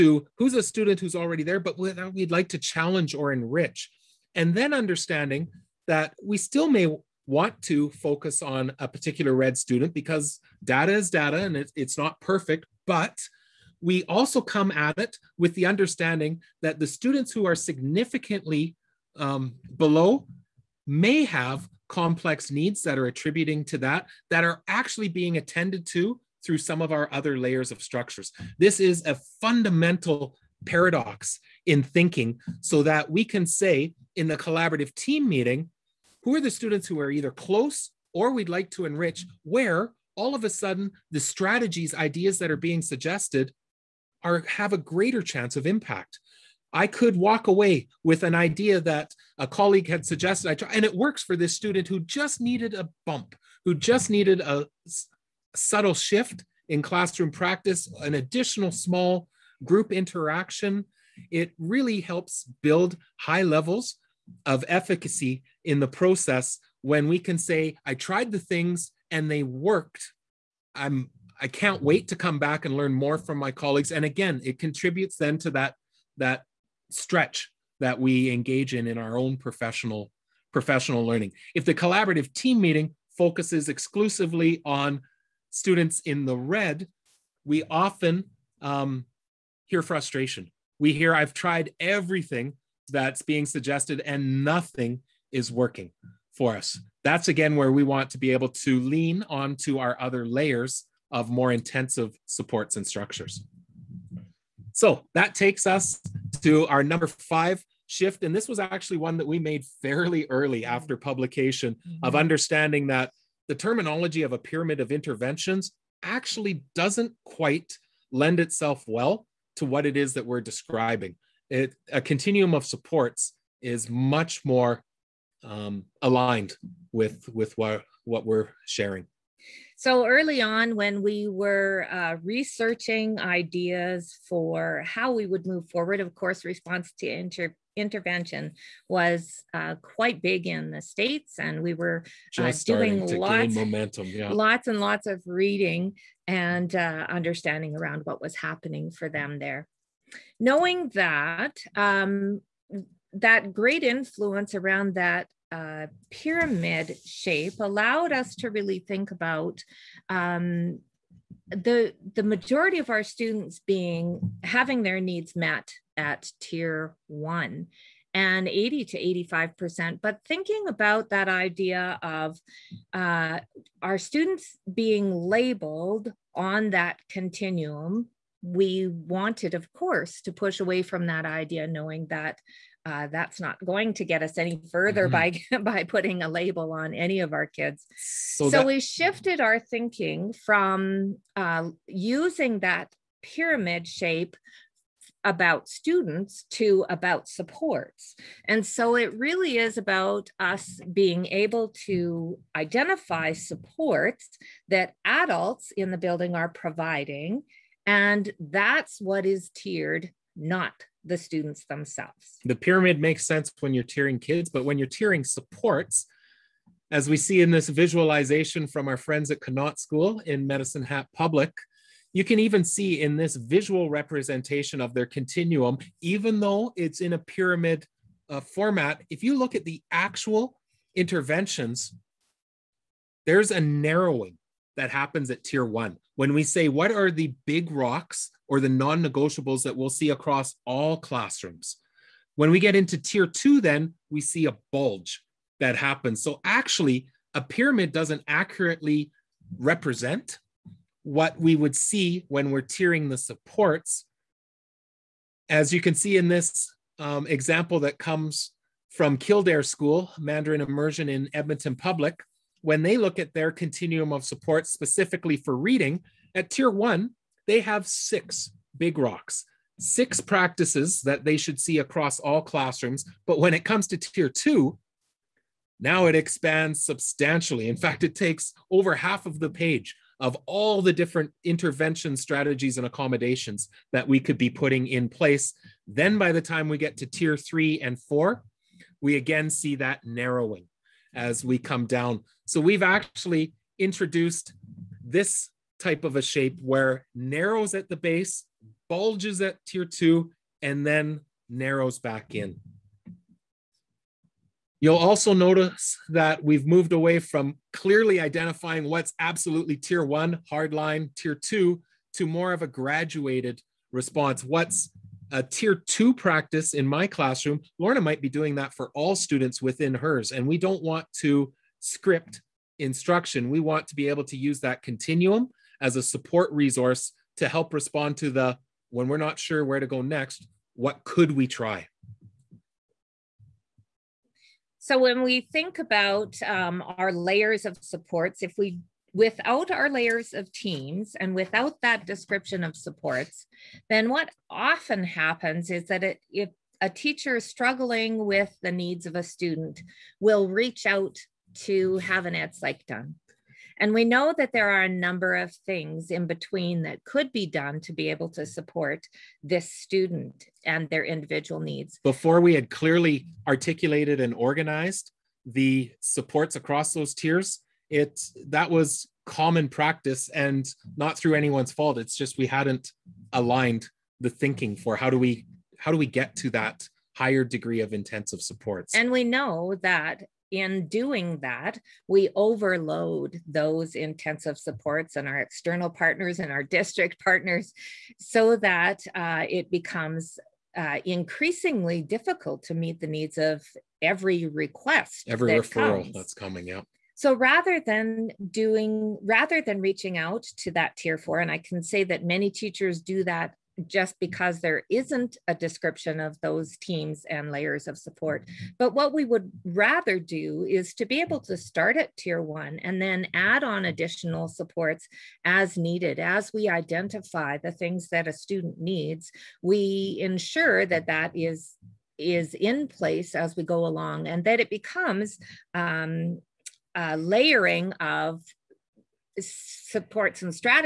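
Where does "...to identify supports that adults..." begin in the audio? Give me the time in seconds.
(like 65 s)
201 s.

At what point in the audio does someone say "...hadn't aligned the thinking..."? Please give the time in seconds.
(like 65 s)
372 s.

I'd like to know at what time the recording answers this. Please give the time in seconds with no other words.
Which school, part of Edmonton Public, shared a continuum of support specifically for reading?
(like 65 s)
259 s.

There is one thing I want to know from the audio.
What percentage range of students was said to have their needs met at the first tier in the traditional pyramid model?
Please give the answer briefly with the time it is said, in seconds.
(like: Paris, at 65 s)
80 to 85 percent, at 168 s.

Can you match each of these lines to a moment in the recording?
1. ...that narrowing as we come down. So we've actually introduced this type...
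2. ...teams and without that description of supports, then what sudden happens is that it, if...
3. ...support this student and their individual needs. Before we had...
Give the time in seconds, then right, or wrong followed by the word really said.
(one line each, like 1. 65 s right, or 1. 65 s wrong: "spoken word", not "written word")
1. 289 s right
2. 340 s wrong: "often", not "sudden"
3. 358 s right.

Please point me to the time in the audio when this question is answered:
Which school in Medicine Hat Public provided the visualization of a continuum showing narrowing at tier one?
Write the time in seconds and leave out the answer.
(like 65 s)
219 s.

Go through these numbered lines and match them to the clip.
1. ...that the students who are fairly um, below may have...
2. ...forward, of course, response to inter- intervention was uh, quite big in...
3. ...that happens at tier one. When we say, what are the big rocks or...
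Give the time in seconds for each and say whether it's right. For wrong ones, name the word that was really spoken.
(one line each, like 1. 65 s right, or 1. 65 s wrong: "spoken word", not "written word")
1. 16 s wrong: "significantly", not "fairly"
2. 135 s right
3. 234 s right.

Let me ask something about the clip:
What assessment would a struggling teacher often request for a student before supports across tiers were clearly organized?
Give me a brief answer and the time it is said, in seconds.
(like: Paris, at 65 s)
ed psych, at 352 s.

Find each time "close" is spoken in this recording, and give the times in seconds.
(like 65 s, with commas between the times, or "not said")
37 s.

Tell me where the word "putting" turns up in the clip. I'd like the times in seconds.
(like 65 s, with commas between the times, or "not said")
185 s, 284 s.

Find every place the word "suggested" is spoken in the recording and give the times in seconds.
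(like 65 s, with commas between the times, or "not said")
42 s, 50 s, 93 s.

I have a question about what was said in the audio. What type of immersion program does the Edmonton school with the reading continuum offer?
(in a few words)
Mandarin Immersion.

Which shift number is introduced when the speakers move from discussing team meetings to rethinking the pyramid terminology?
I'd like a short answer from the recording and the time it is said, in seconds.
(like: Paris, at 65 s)
5, at 107 s.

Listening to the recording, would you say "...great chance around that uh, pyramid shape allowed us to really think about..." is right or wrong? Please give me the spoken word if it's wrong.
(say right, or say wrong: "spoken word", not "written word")
wrong: "influence", not "chance".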